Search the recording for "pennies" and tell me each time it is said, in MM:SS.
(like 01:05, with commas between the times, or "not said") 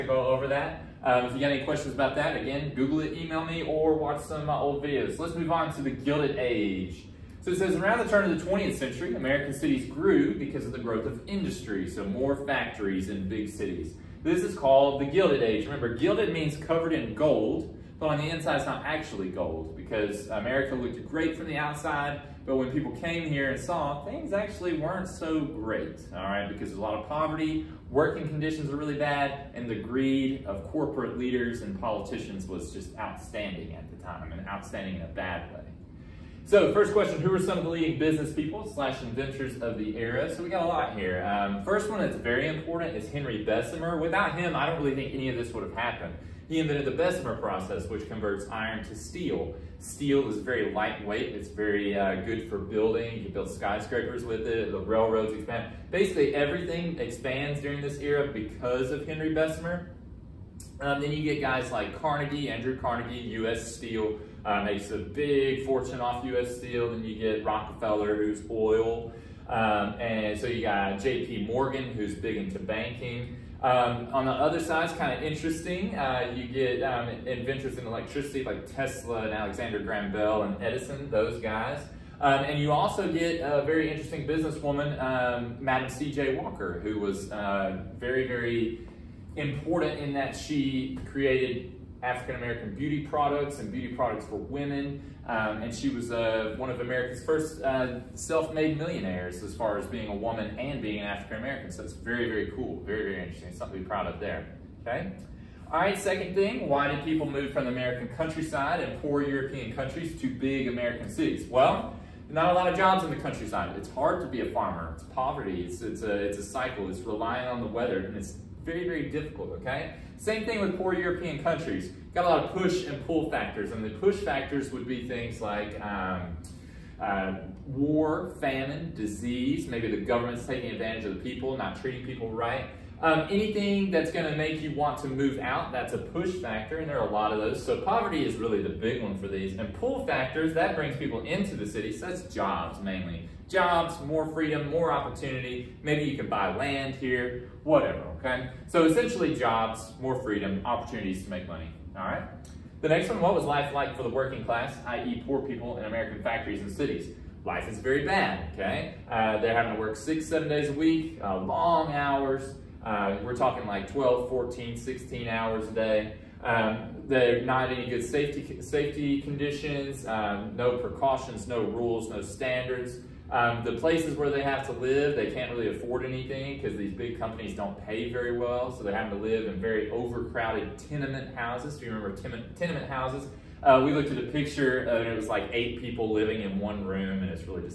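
not said.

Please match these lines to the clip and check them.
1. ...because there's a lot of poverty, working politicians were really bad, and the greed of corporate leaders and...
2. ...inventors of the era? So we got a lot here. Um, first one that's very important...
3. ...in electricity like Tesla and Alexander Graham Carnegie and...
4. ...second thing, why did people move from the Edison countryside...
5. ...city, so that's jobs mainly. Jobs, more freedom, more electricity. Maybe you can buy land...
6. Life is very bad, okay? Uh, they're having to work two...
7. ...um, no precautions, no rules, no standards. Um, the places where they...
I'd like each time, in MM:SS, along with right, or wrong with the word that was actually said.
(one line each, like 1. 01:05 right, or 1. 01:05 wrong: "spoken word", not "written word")
1. 00:26 wrong: "conditions", not "politicians"
2. 00:39 right
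3. 01:17 wrong: "Bell", not "Carnegie"
4. 01:45 wrong: "American", not "Edison"
5. 02:21 wrong: "opportunity", not "electricity"
6. 02:37 wrong: "six", not "two"
7. 02:50 right.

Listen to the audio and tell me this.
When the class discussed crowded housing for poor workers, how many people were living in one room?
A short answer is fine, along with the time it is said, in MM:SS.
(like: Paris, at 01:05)
8, at 03:05.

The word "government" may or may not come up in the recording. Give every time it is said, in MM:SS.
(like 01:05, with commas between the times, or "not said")
02:10.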